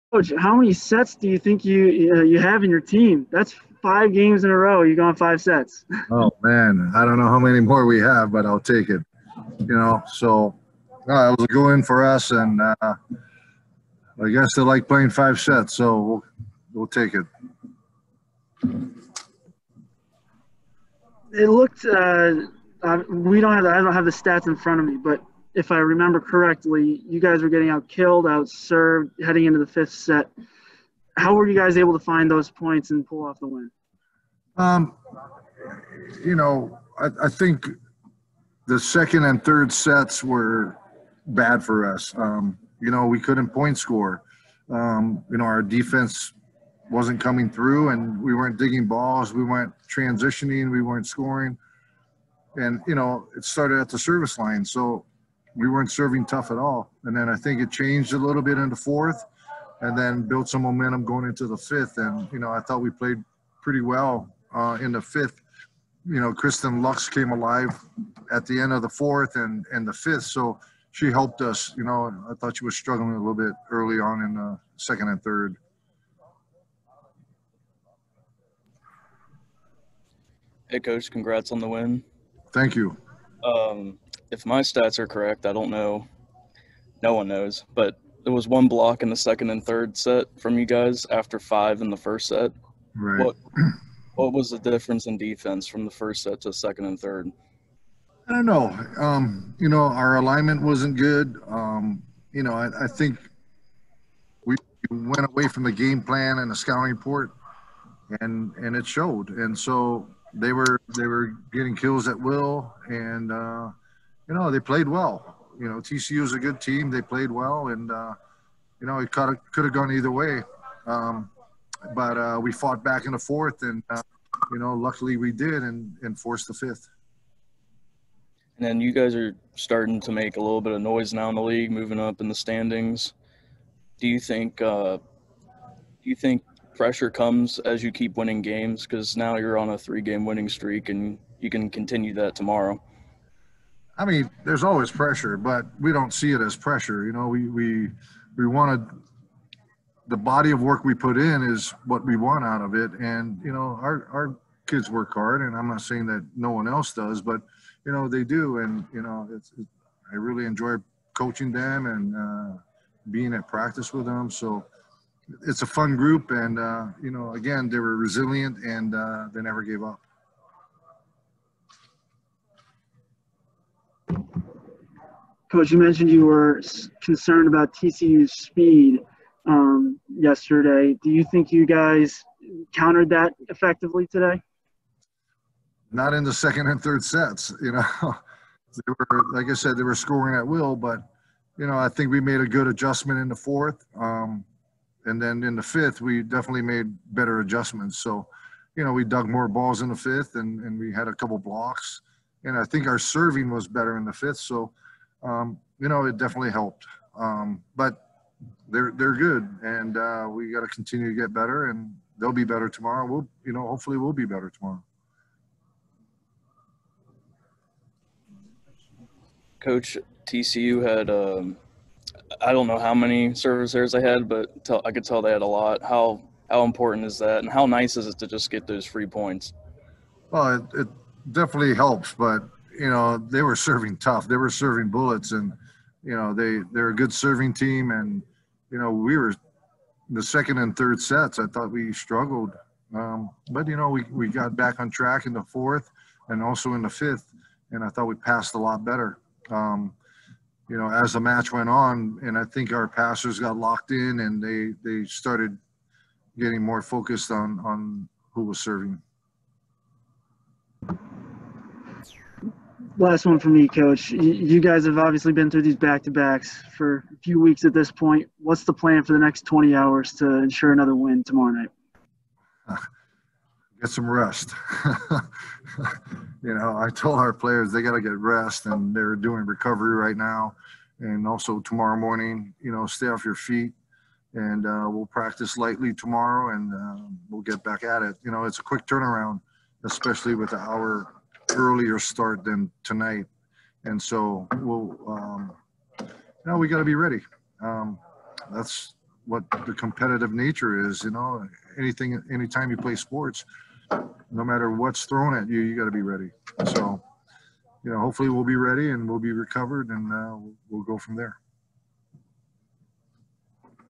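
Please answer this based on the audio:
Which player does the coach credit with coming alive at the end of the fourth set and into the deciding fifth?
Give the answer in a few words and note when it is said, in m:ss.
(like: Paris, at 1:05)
Kristen Lux, at 1:06.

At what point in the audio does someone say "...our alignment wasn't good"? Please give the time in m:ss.
1:39.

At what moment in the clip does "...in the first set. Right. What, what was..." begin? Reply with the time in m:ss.
1:31.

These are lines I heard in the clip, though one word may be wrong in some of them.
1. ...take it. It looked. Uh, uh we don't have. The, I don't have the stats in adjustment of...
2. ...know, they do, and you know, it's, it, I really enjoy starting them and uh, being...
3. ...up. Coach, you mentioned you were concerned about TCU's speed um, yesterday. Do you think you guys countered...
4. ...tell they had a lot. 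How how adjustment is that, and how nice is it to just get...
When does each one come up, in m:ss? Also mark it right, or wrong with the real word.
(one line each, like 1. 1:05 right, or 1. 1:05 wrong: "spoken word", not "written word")
1. 0:16 wrong: "front", not "adjustment"
2. 2:37 wrong: "coaching", not "starting"
3. 2:49 right
4. 3:45 wrong: "important", not "adjustment".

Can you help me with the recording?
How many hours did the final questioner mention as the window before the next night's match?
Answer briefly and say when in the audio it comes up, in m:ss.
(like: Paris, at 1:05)
20, at 4:29.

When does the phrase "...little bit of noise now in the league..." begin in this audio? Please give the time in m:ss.
2:10.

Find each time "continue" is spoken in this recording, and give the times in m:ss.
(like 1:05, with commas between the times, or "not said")
2:21, 3:30.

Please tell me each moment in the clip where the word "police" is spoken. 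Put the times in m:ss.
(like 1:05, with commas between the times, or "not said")
not said.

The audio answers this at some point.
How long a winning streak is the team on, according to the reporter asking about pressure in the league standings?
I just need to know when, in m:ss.
2:19.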